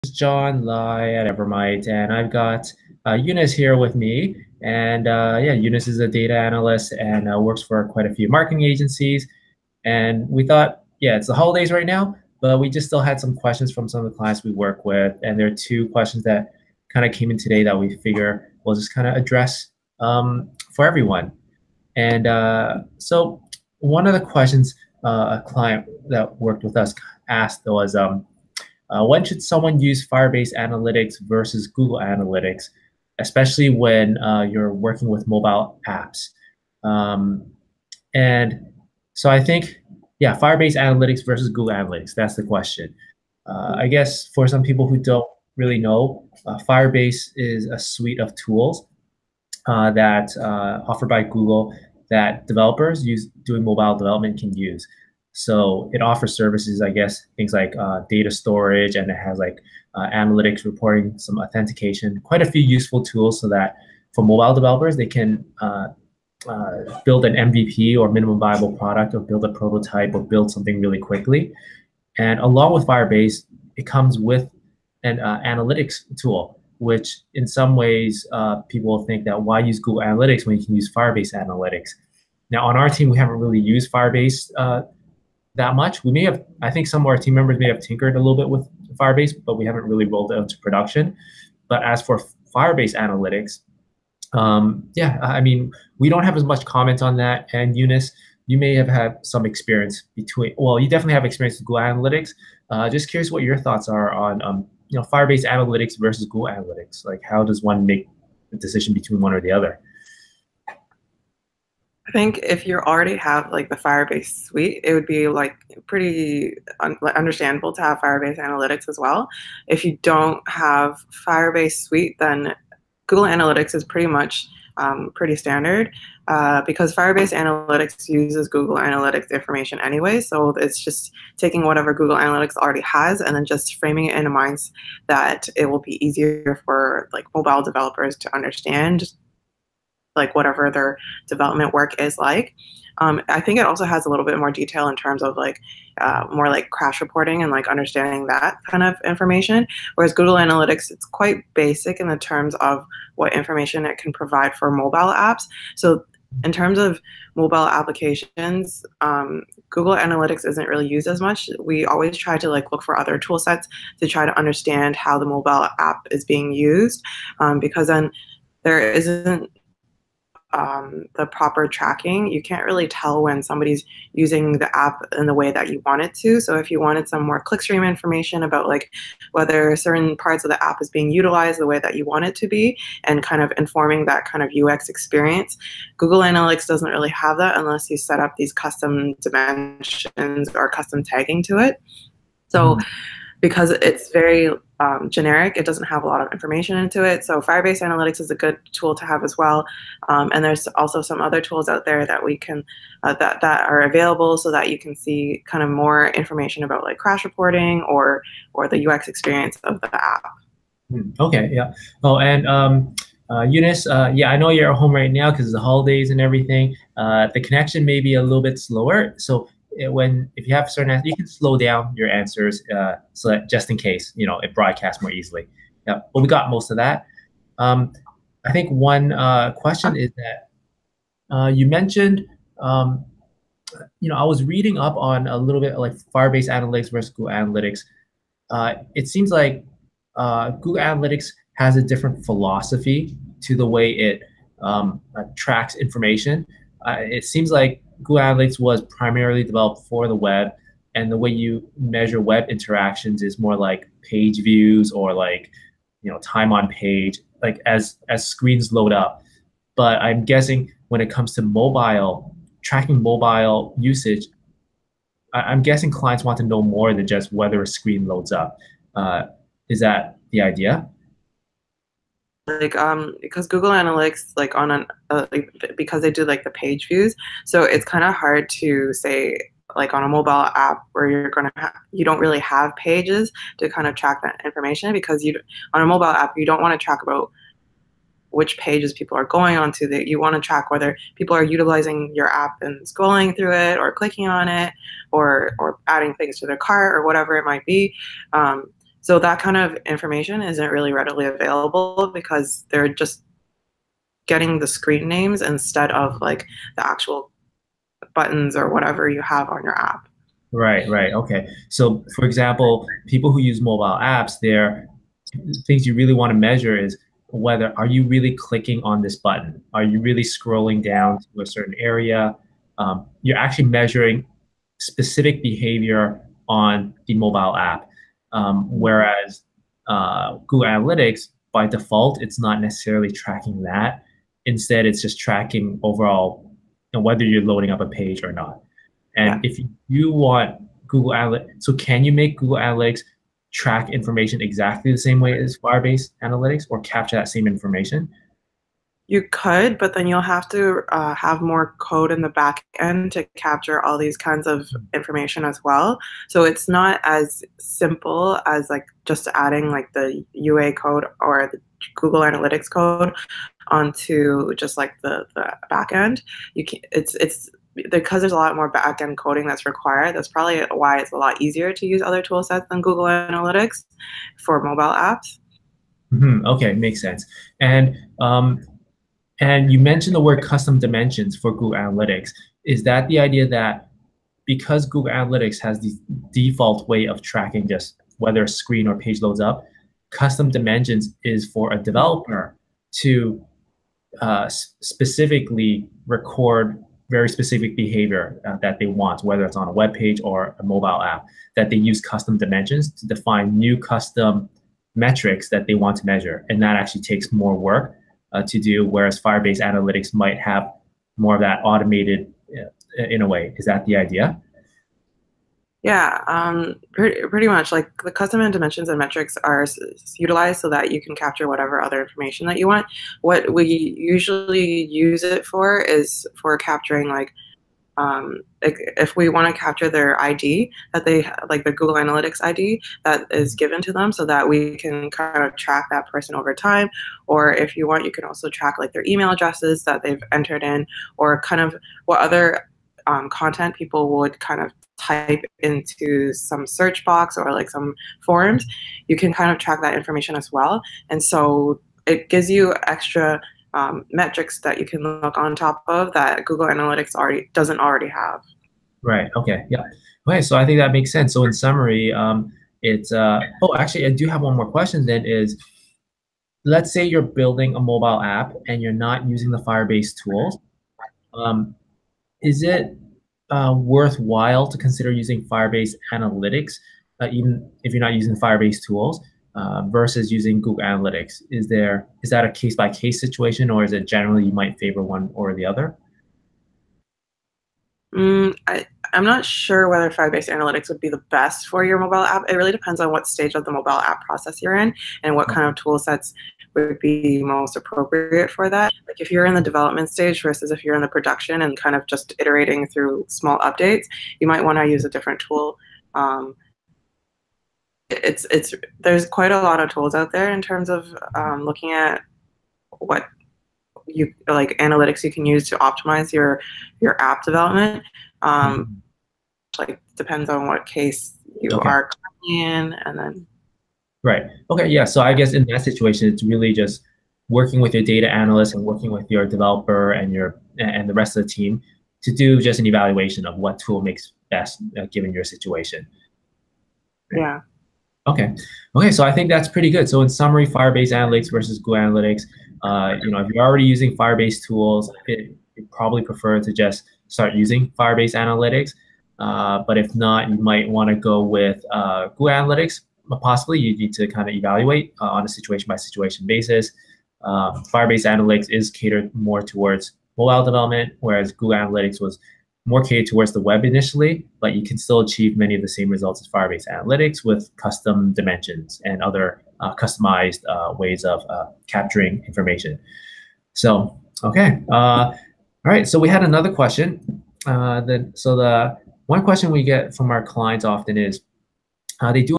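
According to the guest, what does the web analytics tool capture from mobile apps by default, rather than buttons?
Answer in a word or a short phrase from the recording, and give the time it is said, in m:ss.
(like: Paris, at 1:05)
Screen names, at 5:04.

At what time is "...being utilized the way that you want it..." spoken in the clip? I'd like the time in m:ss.
3:00.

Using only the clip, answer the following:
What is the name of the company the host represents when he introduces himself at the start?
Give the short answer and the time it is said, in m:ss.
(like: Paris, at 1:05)
Evermight, at 0:01.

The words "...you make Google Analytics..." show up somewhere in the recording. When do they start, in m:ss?
5:42.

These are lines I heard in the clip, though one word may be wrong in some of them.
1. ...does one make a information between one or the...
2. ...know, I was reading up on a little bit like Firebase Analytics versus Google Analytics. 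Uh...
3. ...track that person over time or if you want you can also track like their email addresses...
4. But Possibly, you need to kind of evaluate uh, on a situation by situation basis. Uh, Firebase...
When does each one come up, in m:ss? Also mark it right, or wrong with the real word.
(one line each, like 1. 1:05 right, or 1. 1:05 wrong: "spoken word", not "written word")
1. 1:47 wrong: "decision", not "information"
2. 3:54 right
3. 7:15 right
4. 9:13 right.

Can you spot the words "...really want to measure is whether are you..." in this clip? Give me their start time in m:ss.
5:15.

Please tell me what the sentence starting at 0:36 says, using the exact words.
Um, and so I think, yeah, Firebase Analytics versus Google Analytics, that's the question.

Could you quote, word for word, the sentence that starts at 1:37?
And Eunice, you may have had some experience between, well, you definitely have experience with Google Analytics.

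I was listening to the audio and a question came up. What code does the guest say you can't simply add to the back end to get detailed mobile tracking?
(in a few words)
UA code.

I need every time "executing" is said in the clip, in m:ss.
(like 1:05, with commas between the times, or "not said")
not said.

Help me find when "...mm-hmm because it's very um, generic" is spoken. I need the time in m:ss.
3:12.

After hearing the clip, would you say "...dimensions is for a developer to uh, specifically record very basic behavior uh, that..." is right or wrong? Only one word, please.
wrong.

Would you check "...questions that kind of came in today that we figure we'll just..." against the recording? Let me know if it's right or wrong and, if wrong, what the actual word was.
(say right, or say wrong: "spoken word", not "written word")
right.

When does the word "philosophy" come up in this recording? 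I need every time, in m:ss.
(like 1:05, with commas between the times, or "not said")
4:02.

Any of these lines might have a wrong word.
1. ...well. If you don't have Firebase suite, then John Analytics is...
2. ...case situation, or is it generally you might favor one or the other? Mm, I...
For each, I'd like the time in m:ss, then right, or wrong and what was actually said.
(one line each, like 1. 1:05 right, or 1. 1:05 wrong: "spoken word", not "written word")
1. 1:58 wrong: "Google", not "John"
2. 8:02 right.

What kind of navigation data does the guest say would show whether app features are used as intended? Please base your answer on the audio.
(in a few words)
Clickstream information.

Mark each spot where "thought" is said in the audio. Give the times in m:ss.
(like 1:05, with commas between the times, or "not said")
0:10, 1:43.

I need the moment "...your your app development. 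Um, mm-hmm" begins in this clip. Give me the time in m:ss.
8:36.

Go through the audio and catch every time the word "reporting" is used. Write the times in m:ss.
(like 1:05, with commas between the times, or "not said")
1:00, 2:27, 3:27.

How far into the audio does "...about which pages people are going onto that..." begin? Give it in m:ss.
4:47.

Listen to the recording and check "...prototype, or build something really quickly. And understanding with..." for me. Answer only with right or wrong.
wrong.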